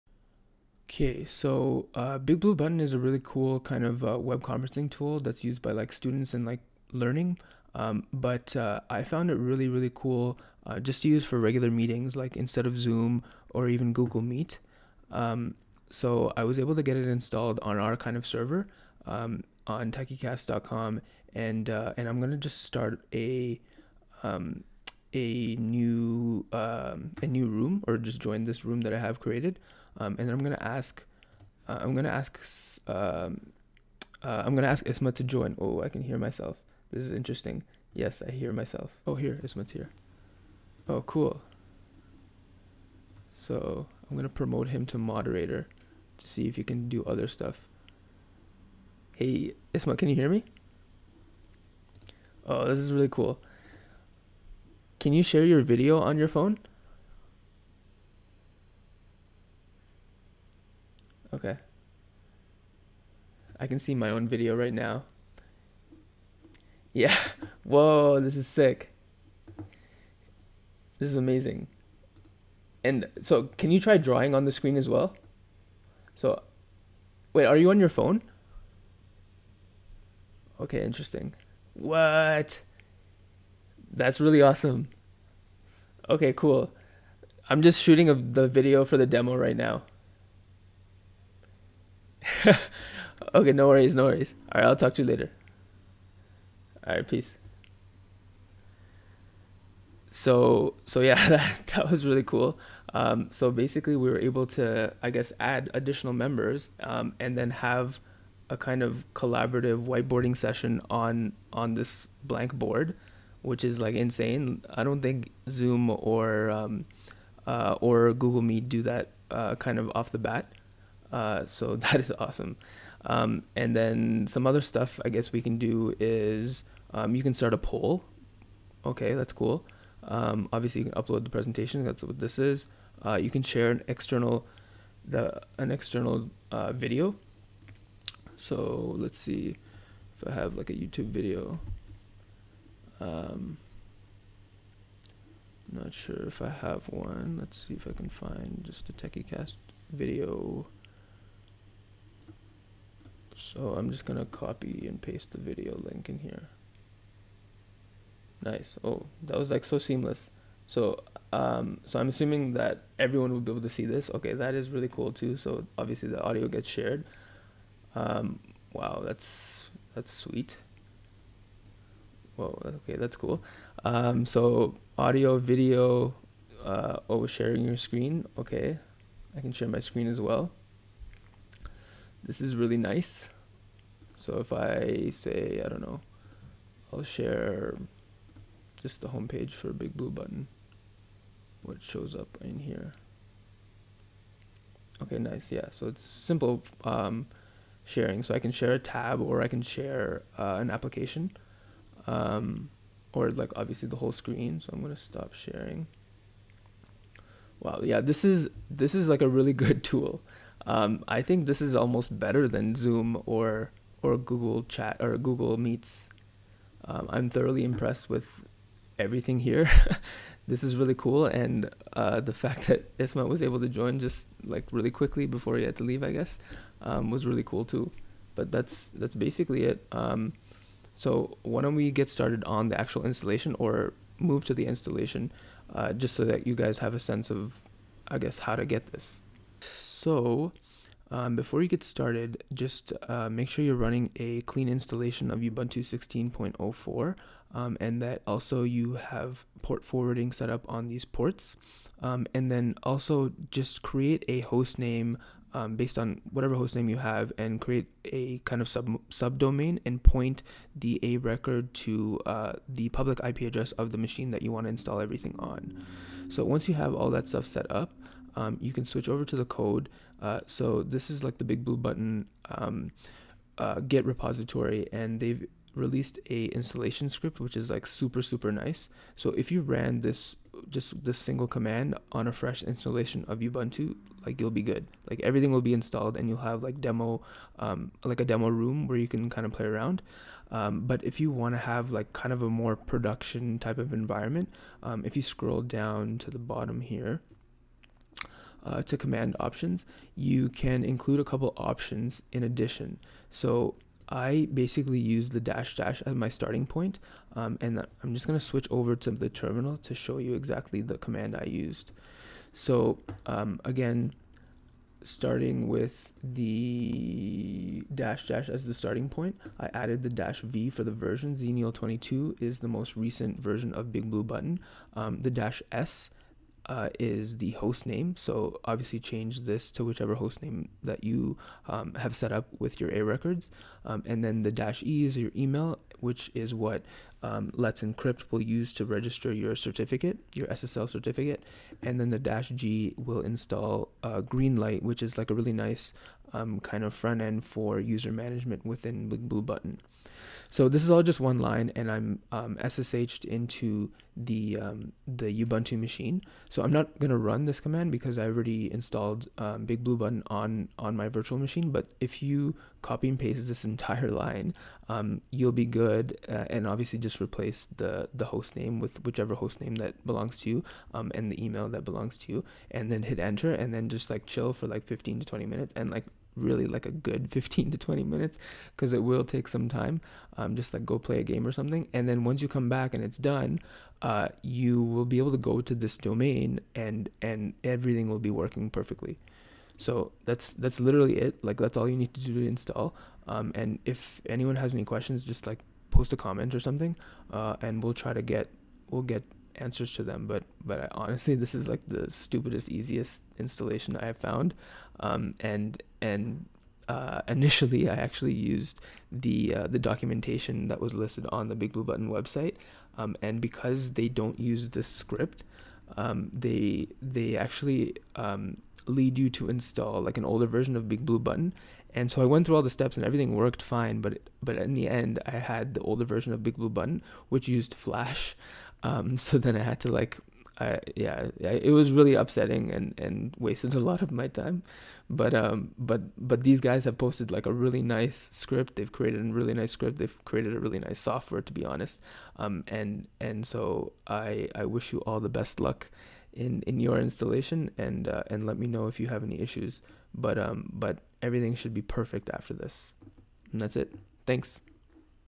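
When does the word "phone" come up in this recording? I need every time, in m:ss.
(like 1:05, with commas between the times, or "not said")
0:56, 1:17.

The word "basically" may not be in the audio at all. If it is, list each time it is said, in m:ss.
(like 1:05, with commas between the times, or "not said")
1:43, 3:49, 5:04.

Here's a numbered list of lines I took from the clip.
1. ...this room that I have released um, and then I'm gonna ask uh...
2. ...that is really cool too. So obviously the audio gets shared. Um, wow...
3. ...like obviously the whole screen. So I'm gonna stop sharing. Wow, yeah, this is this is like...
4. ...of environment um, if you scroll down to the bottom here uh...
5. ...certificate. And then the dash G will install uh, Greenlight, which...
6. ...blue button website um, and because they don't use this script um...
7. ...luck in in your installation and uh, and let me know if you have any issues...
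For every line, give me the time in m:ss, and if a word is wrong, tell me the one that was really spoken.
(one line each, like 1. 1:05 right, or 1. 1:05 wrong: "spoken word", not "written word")
1. 0:28 wrong: "created", not "released"
2. 2:44 right
3. 3:23 right
4. 4:53 right
5. 5:40 right
6. 6:51 right
7. 7:25 right.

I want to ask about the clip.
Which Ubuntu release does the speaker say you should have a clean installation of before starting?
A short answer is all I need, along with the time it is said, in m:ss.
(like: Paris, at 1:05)
Ubuntu 16.04, at 4:05.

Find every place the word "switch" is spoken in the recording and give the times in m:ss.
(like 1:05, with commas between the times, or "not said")
4:28, 5:08.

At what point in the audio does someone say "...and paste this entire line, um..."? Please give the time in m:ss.
6:03.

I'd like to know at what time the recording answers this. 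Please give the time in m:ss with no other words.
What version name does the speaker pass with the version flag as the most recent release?
5:21.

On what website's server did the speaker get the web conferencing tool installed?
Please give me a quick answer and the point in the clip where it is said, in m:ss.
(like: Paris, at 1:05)
techycast.com, at 0:19.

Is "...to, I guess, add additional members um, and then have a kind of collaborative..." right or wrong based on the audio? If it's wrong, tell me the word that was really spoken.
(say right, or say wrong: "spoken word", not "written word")
right.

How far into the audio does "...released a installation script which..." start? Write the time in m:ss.
4:35.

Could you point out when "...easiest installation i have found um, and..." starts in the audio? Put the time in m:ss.
6:42.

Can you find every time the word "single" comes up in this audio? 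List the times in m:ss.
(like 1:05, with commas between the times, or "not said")
4:41.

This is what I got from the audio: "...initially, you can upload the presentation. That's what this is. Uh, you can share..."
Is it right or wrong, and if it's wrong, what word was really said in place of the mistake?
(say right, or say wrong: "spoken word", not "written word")
wrong: "obviously", not "initially".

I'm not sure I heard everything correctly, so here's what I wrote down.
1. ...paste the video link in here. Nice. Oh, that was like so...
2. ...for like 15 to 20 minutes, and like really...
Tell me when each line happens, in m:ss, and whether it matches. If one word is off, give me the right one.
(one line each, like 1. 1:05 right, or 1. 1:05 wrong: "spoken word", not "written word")
1. 2:35 right
2. 6:14 right.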